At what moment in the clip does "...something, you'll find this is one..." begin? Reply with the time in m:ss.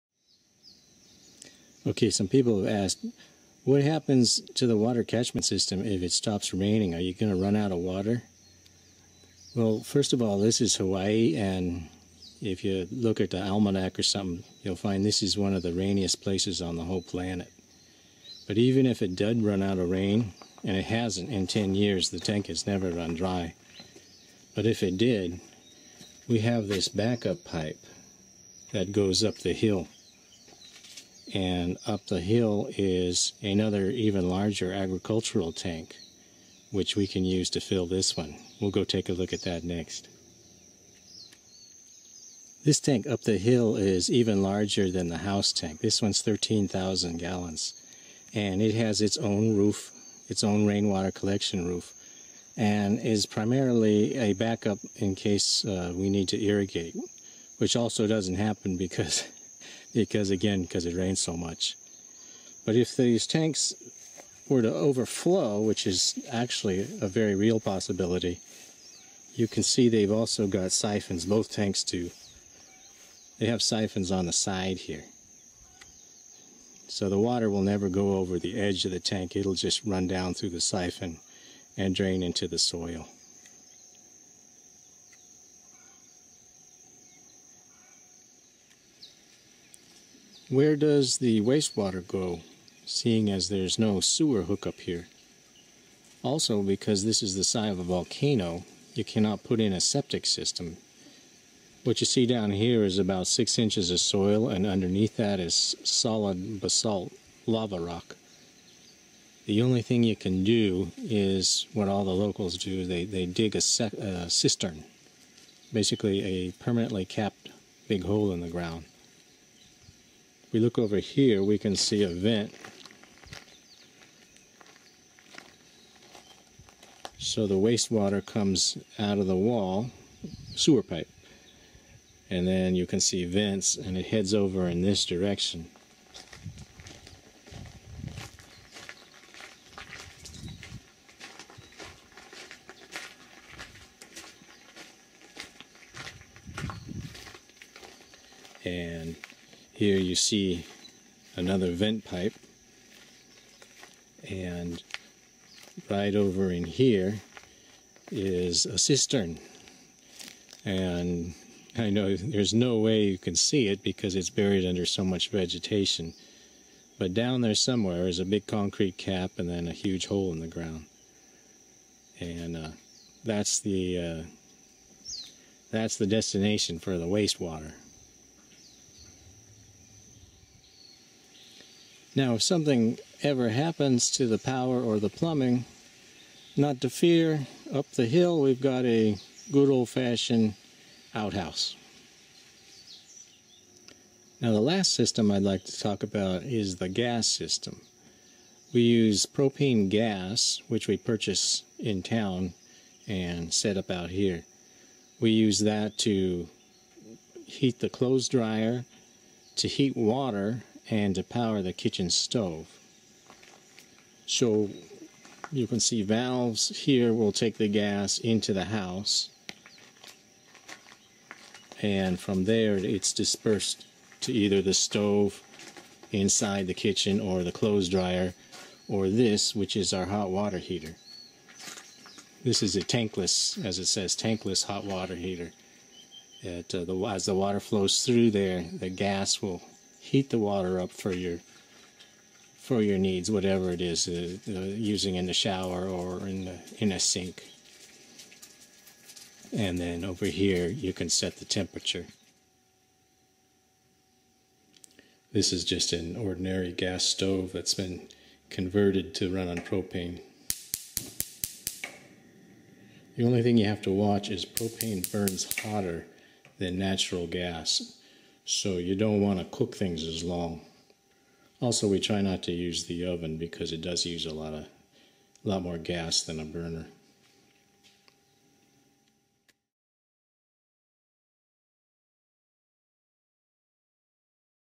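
0:14.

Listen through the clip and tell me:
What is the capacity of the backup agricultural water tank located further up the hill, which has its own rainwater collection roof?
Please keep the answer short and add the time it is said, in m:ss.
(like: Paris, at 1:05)
13,000 gallons, at 0:46.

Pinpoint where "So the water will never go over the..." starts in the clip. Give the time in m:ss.
1:16.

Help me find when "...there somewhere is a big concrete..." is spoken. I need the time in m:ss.
2:47.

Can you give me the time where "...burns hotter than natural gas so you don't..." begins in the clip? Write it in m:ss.
4:25.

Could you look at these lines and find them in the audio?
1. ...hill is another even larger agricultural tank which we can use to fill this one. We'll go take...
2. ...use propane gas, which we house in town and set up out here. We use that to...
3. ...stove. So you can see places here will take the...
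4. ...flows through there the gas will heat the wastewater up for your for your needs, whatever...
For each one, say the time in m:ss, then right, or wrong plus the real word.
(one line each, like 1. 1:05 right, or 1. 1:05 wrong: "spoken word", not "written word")
1. 0:32 right
2. 3:18 wrong: "purchase", not "house"
3. 3:32 wrong: "valves", not "places"
4. 3:57 wrong: "water", not "wastewater".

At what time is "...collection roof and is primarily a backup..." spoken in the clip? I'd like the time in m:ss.
0:51.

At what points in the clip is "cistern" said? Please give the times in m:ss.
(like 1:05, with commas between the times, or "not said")
1:54, 2:38.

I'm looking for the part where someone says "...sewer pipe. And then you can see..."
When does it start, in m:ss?
2:10.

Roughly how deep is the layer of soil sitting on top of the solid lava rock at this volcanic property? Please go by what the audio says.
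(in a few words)
6 inches.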